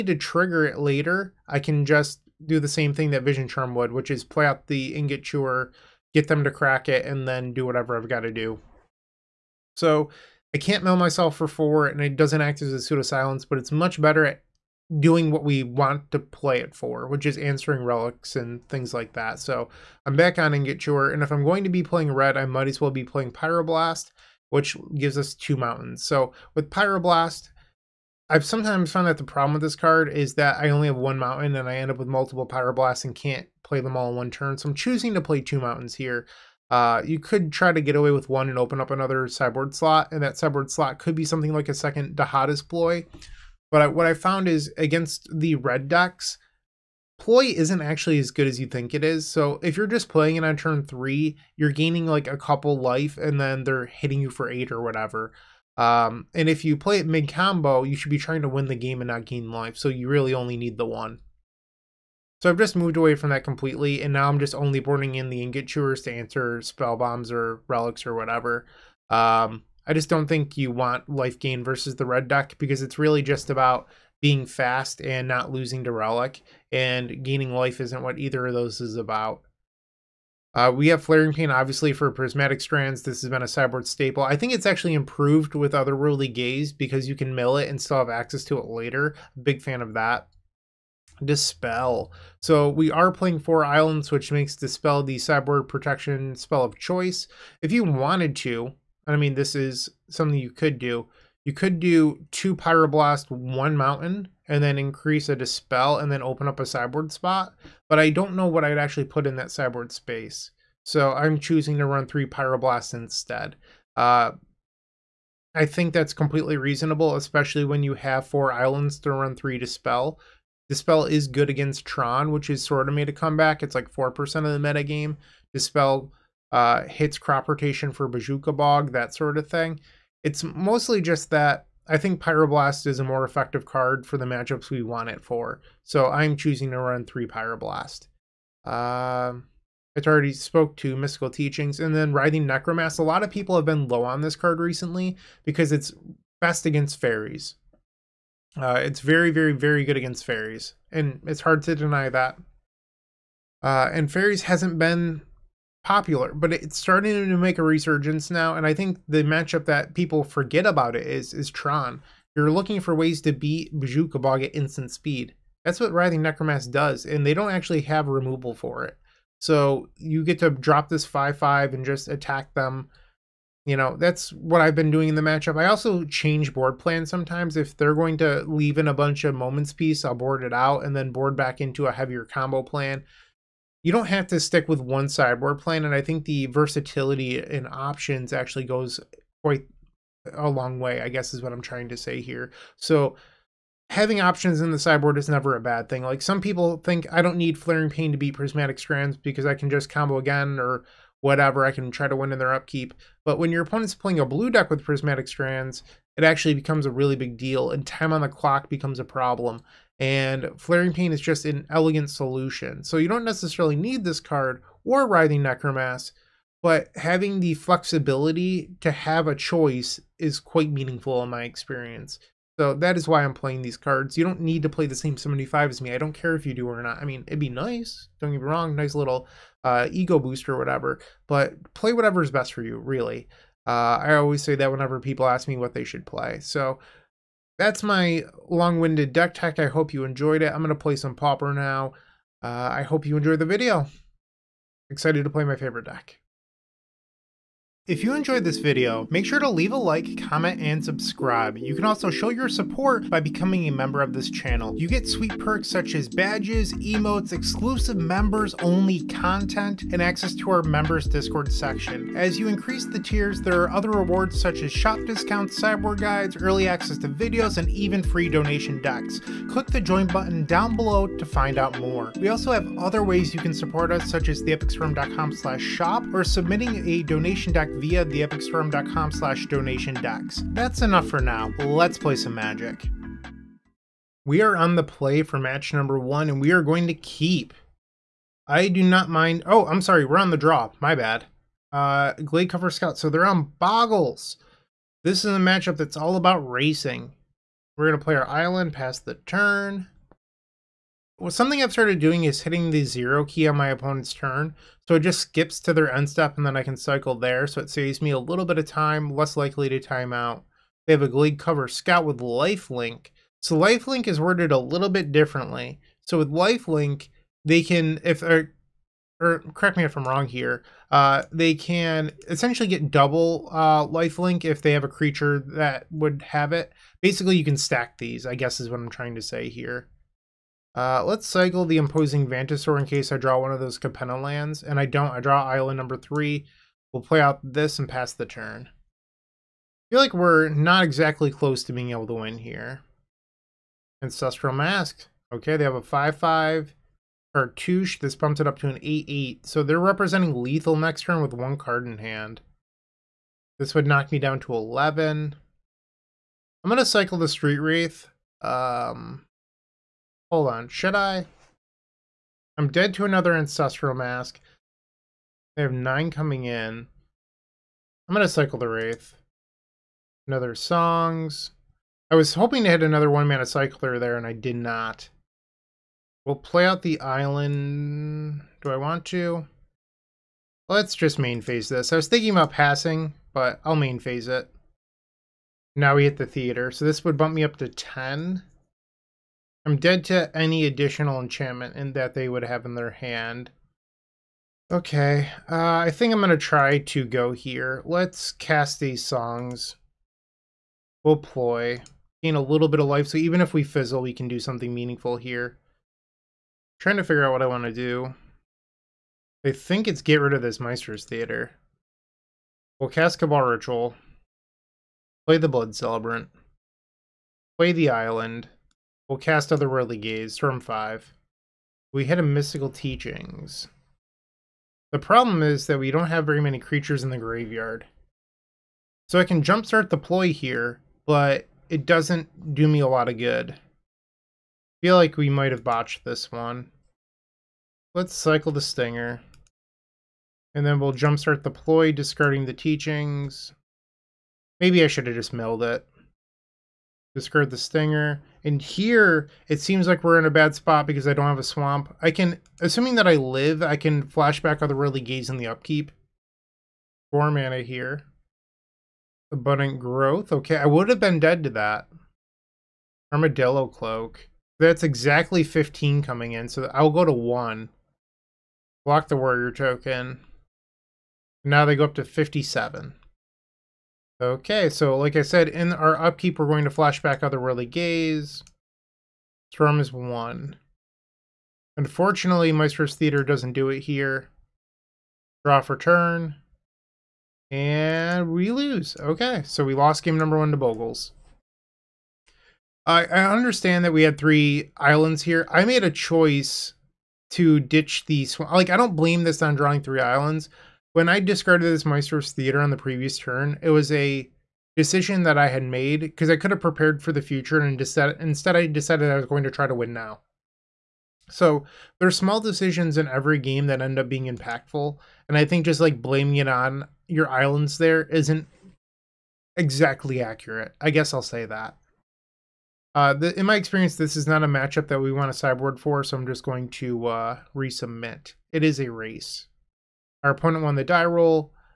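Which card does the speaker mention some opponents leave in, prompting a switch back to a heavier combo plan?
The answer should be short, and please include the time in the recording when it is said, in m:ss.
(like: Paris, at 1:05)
Moment's Peace, at 2:59.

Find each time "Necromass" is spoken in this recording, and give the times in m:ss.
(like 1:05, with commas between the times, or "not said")
2:22, 2:46, 3:35.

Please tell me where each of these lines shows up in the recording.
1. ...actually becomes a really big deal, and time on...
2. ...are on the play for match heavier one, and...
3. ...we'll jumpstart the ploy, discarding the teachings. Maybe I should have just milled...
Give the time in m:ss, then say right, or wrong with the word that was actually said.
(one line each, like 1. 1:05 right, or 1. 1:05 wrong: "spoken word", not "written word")
1. 3:26 right
2. 4:44 wrong: "number", not "heavier"
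3. 7:20 right.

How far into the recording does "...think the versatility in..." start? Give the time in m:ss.
3:06.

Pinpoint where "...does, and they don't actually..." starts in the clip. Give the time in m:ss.
2:46.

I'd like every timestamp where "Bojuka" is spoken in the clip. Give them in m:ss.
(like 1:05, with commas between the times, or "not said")
2:08, 2:43.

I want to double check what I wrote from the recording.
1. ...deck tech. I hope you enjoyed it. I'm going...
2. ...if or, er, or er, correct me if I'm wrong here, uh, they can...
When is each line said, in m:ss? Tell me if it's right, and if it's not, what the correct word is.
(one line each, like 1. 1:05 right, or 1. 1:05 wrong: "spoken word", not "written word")
1. 3:59 right
2. 5:18 right.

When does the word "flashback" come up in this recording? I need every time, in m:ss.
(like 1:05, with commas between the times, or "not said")
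7:34, 7:56.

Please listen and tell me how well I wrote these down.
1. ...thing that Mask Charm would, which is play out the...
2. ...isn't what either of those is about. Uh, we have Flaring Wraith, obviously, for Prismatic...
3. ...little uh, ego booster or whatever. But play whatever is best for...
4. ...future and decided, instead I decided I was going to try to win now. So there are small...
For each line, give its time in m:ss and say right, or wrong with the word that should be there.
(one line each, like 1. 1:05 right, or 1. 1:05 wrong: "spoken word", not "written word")
1. 0:02 wrong: "Vision", not "Mask"
2. 1:17 wrong: "Pain", not "Wraith"
3. 3:48 right
4. 8:27 right.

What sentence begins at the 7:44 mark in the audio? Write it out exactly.
That's exactly 15 coming in, so I'll go to one.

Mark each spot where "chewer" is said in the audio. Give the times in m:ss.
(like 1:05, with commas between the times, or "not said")
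0:05, 0:20, 1:05.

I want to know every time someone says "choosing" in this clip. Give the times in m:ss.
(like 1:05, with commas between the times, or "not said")
0:34, 1:51, 2:16.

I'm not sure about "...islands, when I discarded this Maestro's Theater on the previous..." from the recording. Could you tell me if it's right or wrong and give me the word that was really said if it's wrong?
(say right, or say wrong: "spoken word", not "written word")
right.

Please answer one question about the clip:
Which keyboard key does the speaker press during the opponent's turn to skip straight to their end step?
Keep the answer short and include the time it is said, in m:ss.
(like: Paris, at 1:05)
zero, at 5:02.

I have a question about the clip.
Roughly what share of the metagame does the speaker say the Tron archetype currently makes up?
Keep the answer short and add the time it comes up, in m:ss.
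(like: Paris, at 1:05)
4%, at 2:03.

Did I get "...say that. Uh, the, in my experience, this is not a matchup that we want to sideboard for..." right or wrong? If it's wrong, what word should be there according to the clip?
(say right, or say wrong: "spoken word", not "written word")
right.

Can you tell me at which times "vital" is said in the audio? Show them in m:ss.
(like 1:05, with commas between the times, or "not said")
not said.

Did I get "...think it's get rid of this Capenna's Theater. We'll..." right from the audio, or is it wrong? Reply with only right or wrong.
wrong.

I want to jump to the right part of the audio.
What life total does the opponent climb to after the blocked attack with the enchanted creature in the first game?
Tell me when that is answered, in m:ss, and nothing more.
7:52.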